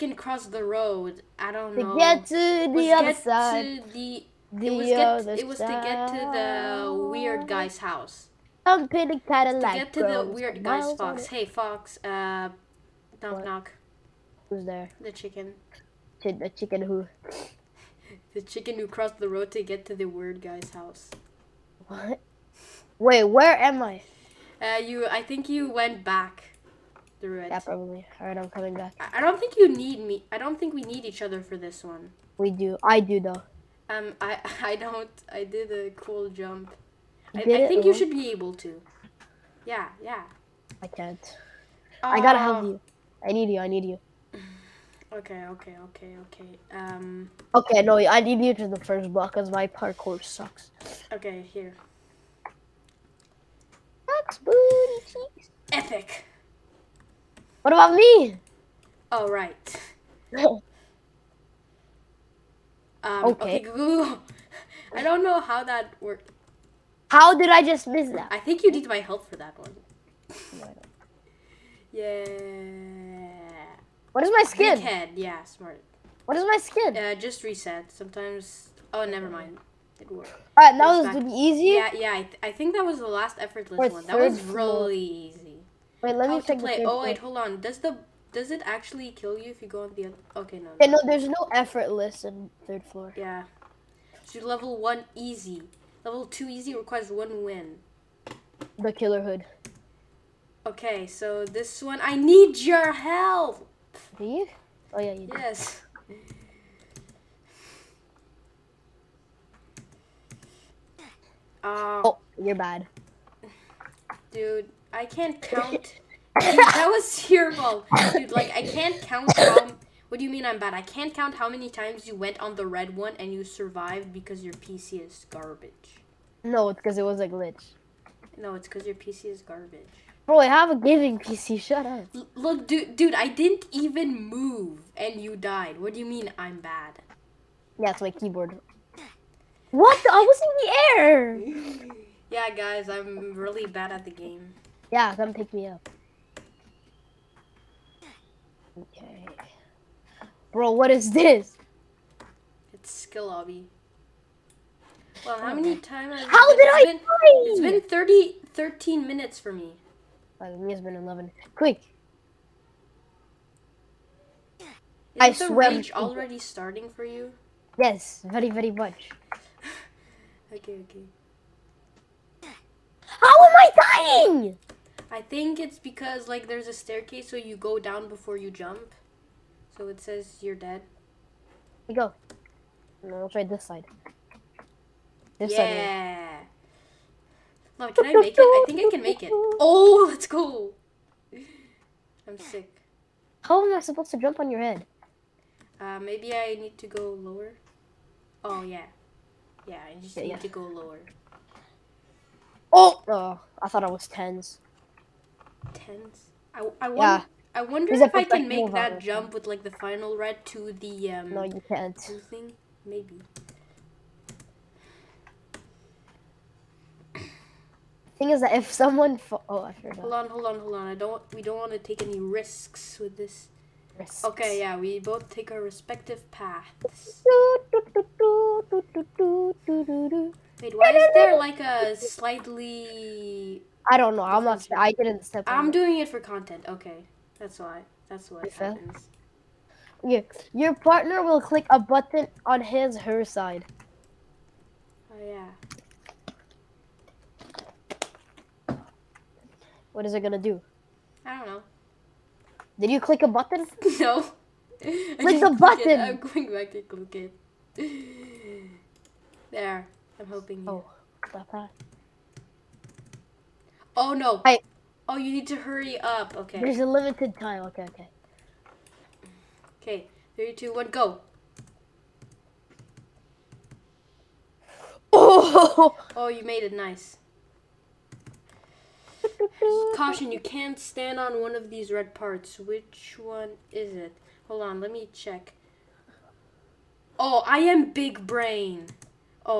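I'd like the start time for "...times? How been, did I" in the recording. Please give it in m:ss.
2:35.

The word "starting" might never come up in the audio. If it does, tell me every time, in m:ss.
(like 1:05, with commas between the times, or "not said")
2:46.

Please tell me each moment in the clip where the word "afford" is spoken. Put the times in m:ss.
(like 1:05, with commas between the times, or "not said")
not said.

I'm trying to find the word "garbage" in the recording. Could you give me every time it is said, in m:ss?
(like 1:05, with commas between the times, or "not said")
2:05, 2:09.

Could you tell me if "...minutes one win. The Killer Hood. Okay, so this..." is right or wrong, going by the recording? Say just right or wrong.
wrong.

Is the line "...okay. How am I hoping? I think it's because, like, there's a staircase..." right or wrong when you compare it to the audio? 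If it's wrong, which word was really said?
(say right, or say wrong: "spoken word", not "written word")
wrong: "dying", not "hoping".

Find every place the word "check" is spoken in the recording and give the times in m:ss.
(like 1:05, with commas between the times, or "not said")
1:26, 4:45.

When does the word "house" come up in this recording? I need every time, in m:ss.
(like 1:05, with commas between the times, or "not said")
0:07, 0:20.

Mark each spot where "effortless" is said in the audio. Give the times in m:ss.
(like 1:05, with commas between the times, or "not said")
1:23, 1:31.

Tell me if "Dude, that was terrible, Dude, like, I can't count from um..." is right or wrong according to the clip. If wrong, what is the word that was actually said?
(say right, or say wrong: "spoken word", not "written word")
right.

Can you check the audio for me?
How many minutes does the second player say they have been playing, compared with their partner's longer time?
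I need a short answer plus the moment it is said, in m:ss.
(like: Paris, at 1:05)
11, at 2:40.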